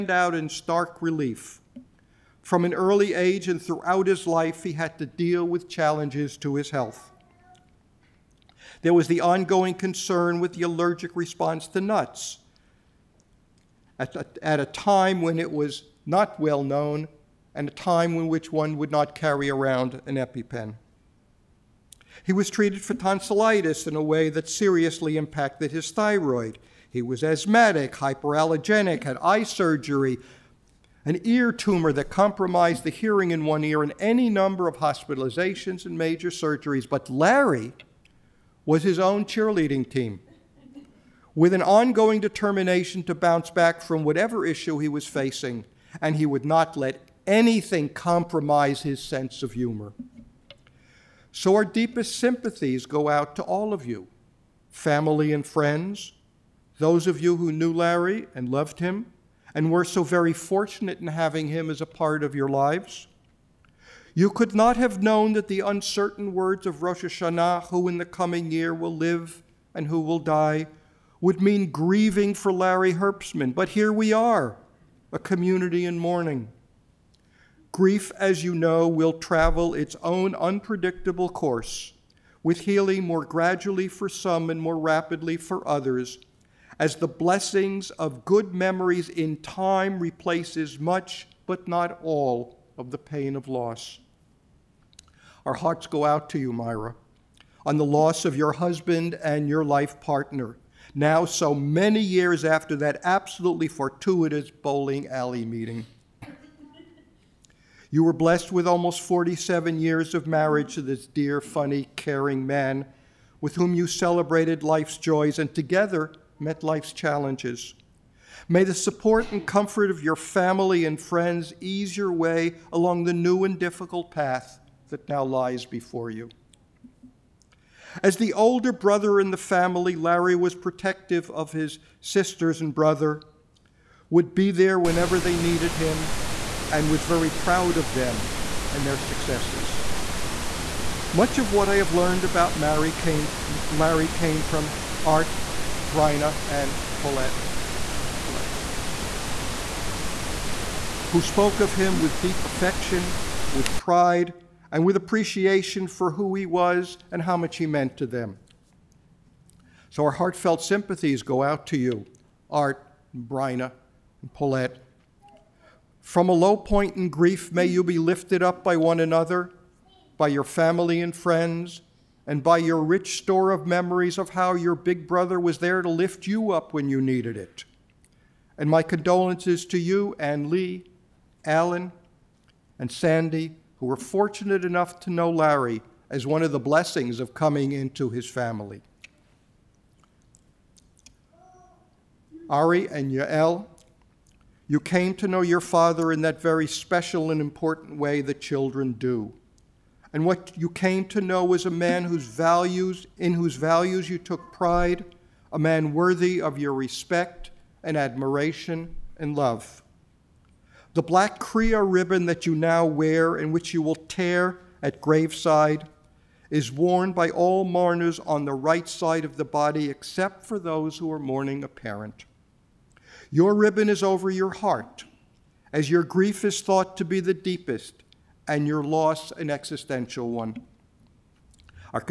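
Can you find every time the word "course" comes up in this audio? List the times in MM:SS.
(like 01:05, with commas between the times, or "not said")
01:21.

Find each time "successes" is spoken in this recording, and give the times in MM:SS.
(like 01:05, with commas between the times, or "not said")
02:18.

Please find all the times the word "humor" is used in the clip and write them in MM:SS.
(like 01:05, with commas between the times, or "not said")
00:49.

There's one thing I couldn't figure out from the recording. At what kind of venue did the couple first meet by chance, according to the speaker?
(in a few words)
Bowling alley.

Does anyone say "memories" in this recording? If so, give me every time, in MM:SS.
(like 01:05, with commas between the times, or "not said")
01:28, 02:53.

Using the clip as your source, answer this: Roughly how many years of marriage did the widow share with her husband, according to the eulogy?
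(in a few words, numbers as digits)
47.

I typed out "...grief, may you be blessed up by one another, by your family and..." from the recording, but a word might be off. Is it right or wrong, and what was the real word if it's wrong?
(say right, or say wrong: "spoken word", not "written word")
wrong: "lifted", not "blessed".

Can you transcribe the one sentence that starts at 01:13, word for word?
But here we are, a community in mourning.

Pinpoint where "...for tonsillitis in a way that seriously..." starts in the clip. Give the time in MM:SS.
00:22.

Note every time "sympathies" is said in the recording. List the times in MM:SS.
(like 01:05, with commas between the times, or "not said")
00:52, 02:40.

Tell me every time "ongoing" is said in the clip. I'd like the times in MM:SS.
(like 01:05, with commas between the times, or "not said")
00:09, 00:41.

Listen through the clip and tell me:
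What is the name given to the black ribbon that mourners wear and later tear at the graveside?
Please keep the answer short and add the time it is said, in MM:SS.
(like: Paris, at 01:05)
Kriya, at 03:31.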